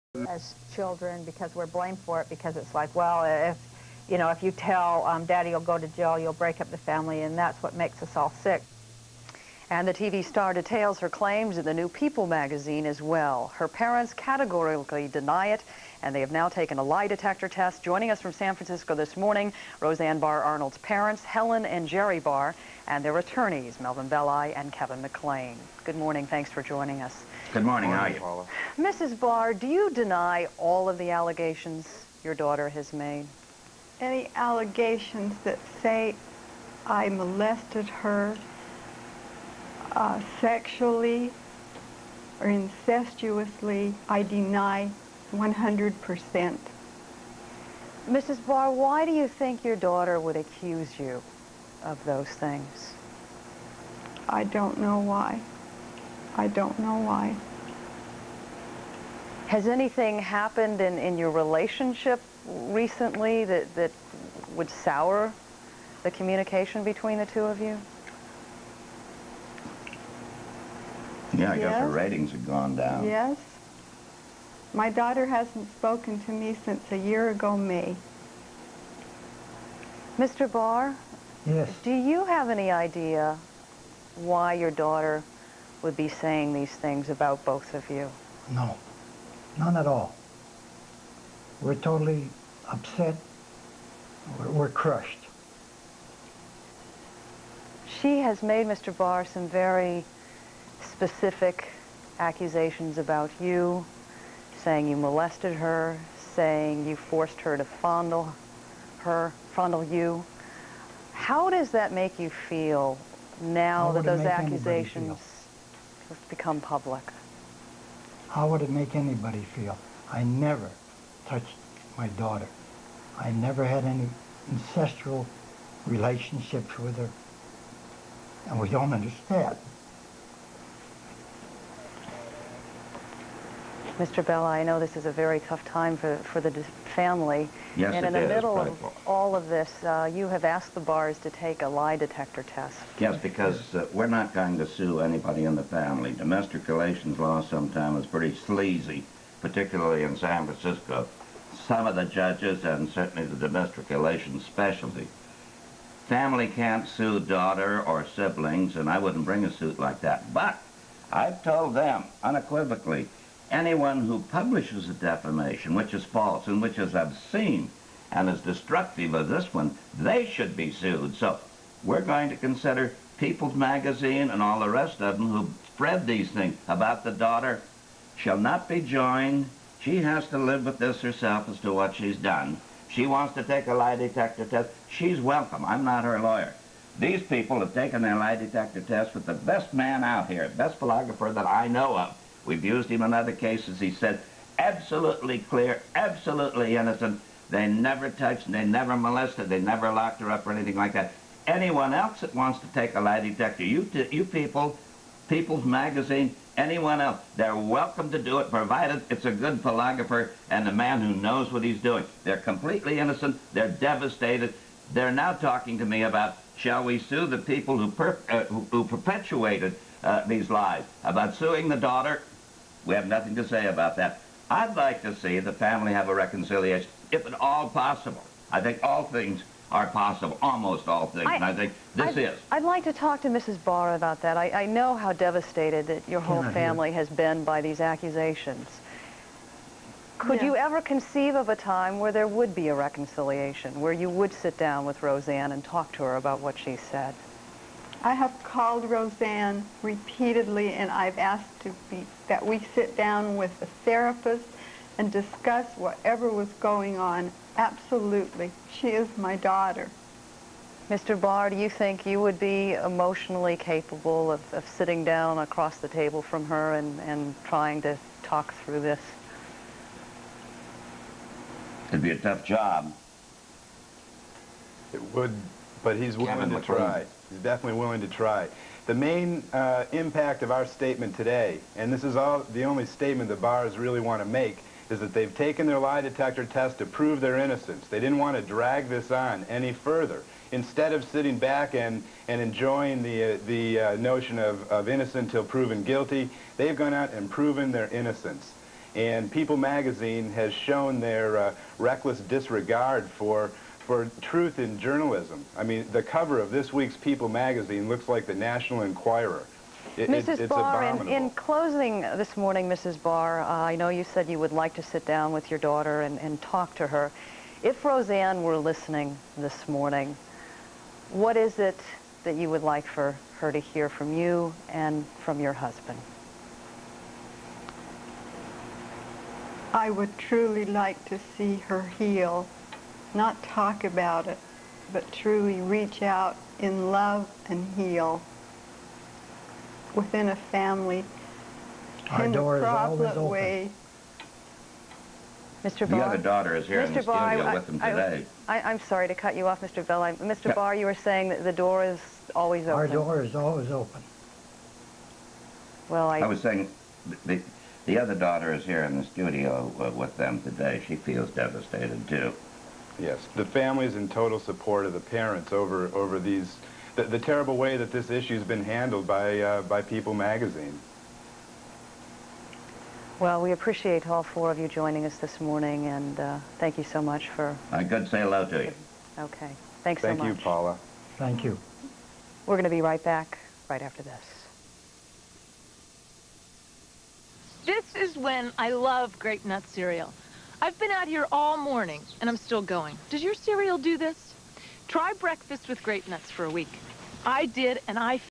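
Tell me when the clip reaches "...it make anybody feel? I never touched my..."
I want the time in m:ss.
1:58.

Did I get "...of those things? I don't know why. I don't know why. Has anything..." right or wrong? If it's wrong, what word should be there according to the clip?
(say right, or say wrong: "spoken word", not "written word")
right.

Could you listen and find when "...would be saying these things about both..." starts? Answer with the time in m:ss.
1:25.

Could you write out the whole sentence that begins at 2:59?
She has to live with this herself as to what she's done.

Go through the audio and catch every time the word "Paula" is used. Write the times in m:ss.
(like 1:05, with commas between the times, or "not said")
0:28, 6:20.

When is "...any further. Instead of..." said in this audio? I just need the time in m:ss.
4:49.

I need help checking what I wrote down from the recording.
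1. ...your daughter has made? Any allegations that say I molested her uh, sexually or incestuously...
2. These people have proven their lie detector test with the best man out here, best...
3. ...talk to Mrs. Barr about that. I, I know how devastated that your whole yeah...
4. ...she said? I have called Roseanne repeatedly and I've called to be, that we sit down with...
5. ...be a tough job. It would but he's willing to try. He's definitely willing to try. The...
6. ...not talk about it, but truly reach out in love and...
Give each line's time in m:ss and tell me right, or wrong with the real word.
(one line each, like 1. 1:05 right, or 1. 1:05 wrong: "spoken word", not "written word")
1. 0:32 right
2. 3:06 wrong: "taken", not "proven"
3. 3:52 right
4. 4:06 wrong: "asked", not "called"
5. 4:32 right
6. 5:33 right.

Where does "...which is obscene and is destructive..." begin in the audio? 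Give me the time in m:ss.
2:46.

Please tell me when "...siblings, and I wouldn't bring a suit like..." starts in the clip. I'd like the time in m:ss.
2:38.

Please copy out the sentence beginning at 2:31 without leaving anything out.
Some of the judges and certainly the domestic relations specialty.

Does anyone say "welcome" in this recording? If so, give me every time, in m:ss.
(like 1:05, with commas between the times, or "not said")
3:05, 3:27.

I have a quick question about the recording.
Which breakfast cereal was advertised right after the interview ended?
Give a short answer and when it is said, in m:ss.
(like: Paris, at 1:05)
Grape-Nuts, at 6:29.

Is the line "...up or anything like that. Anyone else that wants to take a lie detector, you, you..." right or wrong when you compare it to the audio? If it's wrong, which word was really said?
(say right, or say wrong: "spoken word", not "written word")
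right.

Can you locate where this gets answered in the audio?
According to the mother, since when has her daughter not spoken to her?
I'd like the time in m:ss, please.
1:16.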